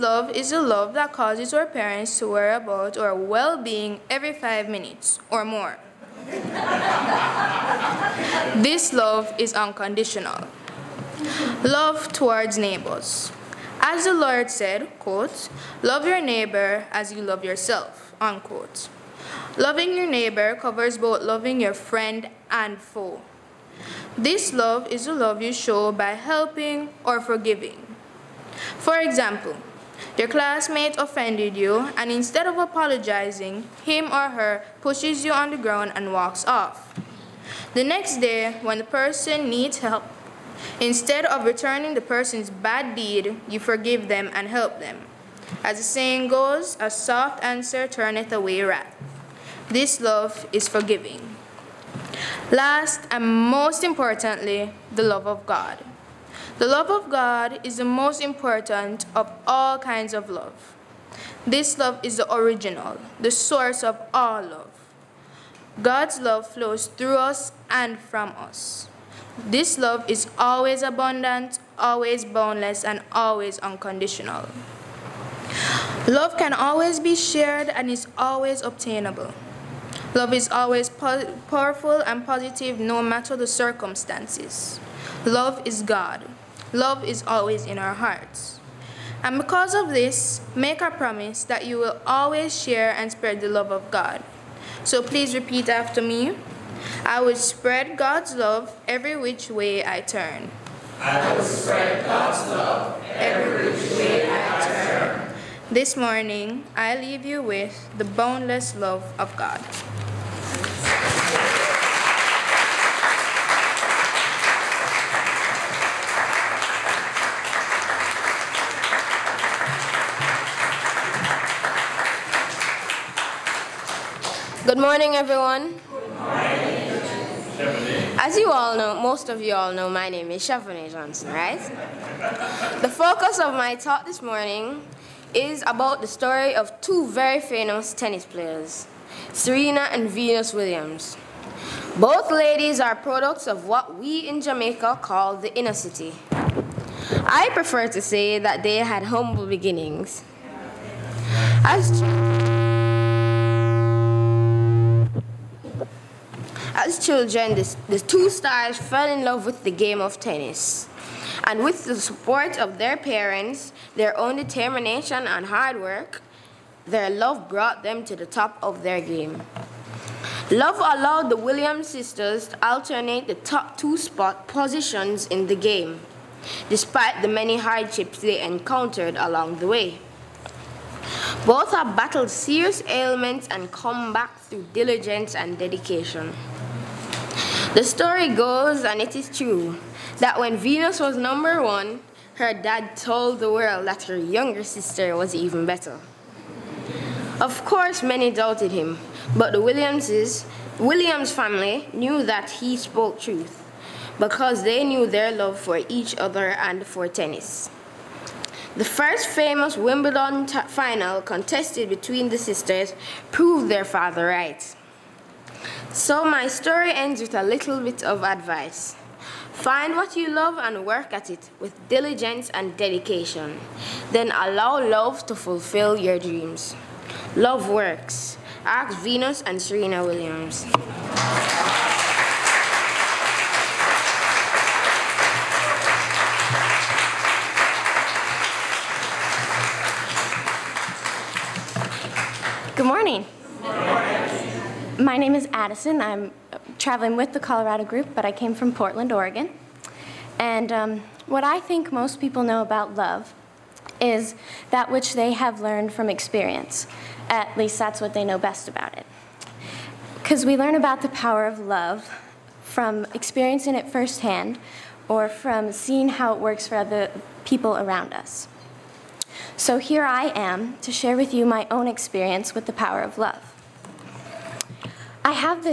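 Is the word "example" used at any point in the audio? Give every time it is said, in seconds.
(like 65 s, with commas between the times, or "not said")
29 s.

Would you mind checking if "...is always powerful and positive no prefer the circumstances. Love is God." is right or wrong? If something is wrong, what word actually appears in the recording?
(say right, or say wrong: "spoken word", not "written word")
wrong: "matter", not "prefer".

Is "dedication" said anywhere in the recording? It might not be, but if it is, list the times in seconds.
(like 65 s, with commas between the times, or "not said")
185 s, 222 s.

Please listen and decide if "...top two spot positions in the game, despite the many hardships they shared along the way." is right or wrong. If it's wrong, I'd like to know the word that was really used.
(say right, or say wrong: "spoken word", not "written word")
wrong: "encountered", not "shared".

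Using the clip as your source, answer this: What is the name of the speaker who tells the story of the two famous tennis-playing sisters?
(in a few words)
Shavanie Johnson.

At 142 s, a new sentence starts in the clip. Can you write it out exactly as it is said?
Both ladies are products of what we in Jamaica call the inner city.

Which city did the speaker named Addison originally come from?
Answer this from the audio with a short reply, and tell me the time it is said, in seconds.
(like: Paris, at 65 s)
Portland, Oregon, at 248 s.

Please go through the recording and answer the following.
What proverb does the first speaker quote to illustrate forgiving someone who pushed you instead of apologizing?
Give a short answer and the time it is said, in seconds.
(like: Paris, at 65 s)
A soft answer turneth away wrath, at 46 s.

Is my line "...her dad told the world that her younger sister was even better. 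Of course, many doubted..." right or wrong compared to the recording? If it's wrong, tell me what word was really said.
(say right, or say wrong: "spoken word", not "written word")
right.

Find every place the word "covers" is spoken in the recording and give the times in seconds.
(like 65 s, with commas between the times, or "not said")
20 s.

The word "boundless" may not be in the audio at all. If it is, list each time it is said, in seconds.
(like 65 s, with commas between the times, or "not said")
72 s, 108 s.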